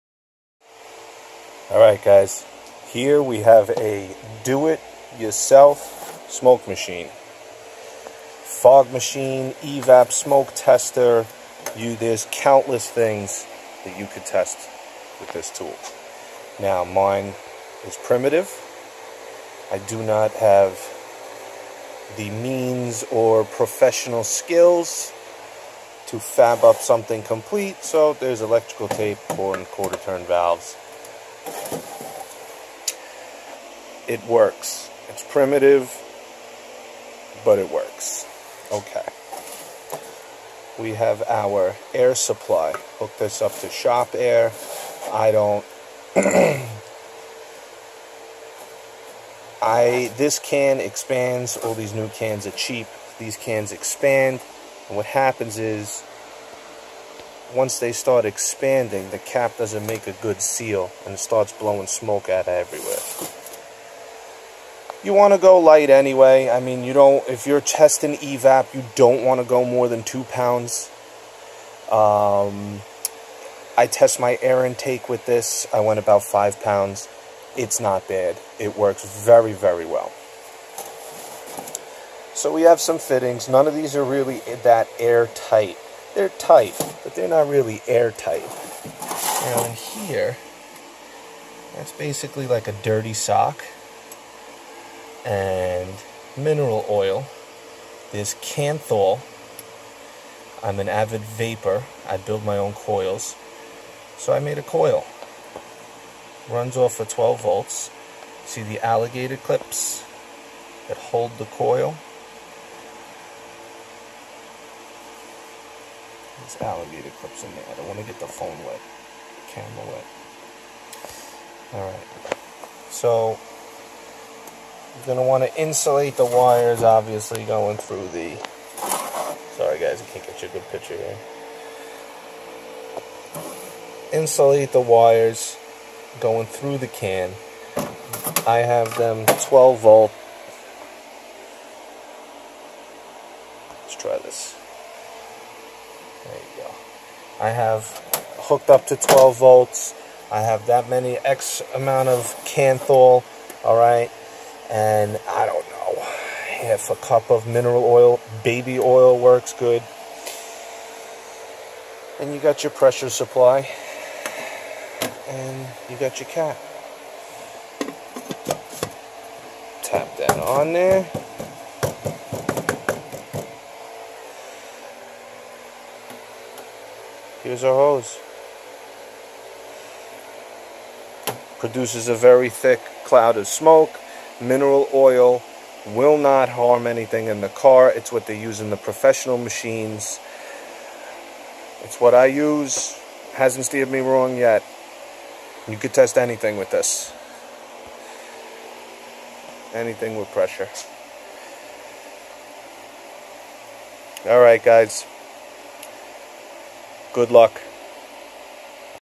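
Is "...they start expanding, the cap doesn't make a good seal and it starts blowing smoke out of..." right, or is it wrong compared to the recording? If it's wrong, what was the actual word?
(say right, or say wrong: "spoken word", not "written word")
right.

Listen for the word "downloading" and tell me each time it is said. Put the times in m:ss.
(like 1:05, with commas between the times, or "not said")
not said.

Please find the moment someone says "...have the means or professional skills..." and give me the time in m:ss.
0:20.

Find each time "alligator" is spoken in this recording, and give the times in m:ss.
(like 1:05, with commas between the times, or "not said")
1:48, 1:56.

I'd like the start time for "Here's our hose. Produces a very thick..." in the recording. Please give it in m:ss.
2:57.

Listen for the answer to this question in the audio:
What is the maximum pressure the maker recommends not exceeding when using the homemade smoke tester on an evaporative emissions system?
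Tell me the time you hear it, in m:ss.
1:10.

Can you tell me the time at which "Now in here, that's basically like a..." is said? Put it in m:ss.
1:29.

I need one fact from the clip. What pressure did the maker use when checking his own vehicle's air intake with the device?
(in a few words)
5 pounds.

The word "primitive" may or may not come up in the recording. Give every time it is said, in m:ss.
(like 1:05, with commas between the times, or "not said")
0:18, 0:35.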